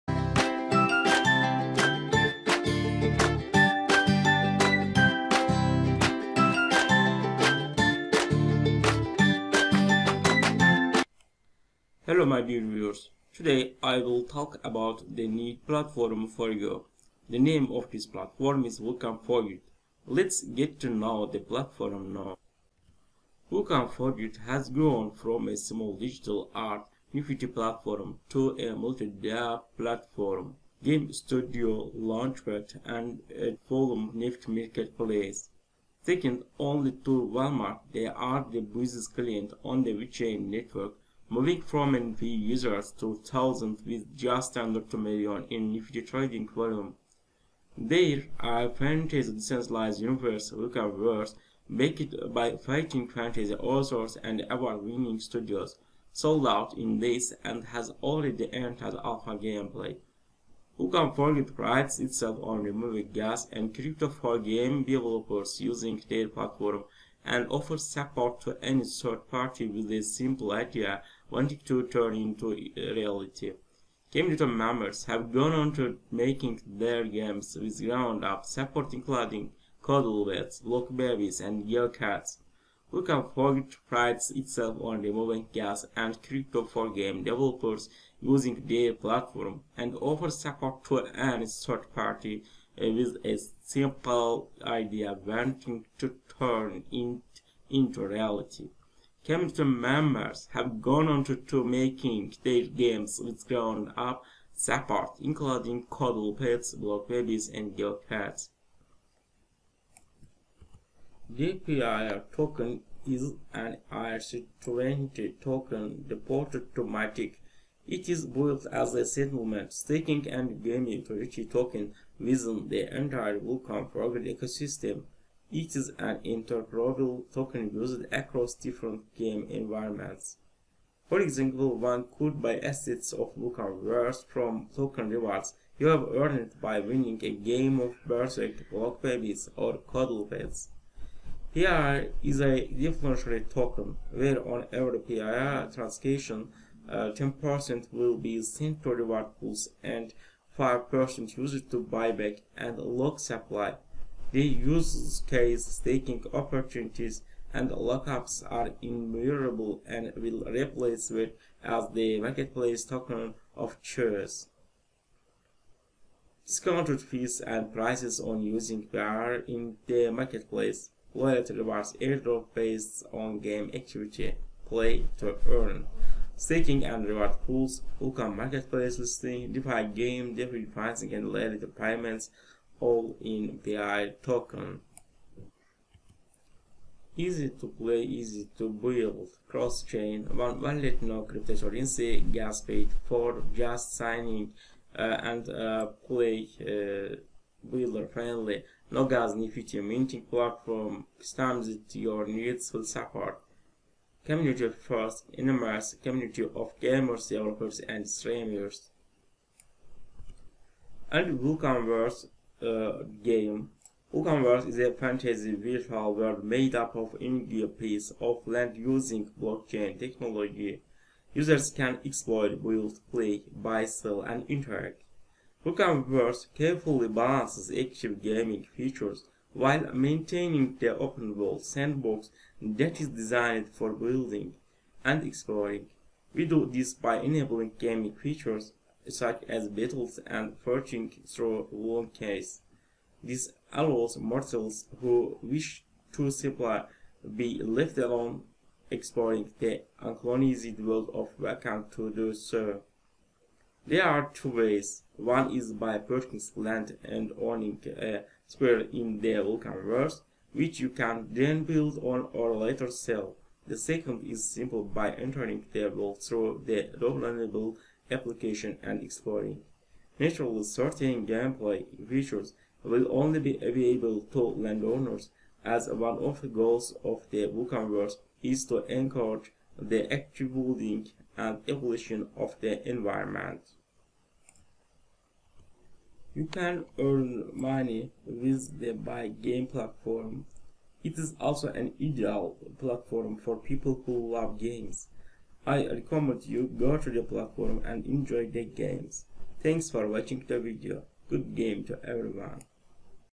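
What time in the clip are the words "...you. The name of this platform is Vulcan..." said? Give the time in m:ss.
0:16.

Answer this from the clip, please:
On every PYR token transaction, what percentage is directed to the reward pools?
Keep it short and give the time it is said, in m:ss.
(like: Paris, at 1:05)
10%, at 2:26.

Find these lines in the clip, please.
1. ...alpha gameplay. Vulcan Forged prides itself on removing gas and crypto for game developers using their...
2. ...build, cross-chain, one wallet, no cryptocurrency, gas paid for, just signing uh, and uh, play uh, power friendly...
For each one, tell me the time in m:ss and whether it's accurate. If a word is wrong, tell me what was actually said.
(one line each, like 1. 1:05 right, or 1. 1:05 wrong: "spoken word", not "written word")
1. 0:59 right
2. 3:08 wrong: "builder", not "power".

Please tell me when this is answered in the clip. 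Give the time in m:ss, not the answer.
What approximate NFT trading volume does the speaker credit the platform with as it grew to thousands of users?
0:44.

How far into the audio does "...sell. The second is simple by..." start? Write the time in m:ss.
4:22.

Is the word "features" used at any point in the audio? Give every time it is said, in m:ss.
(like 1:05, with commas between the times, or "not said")
3:48, 3:58, 4:32.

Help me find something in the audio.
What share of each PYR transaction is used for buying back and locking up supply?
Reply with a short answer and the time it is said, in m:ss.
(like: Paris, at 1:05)
5%, at 2:30.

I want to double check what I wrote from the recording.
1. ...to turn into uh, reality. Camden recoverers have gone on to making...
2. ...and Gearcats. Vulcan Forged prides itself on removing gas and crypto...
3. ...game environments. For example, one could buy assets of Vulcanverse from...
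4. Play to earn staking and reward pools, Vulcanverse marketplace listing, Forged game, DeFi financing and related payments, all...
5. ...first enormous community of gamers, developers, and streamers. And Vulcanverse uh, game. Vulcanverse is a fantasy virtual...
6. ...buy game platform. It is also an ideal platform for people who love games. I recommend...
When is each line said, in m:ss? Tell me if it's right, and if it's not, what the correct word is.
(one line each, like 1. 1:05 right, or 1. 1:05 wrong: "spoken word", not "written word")
1. 1:11 wrong: "members", not "recoverers"
2. 1:21 right
3. 2:09 right
4. 2:54 wrong: "DeFi", not "Forged"
5. 3:24 right
6. 4:48 right.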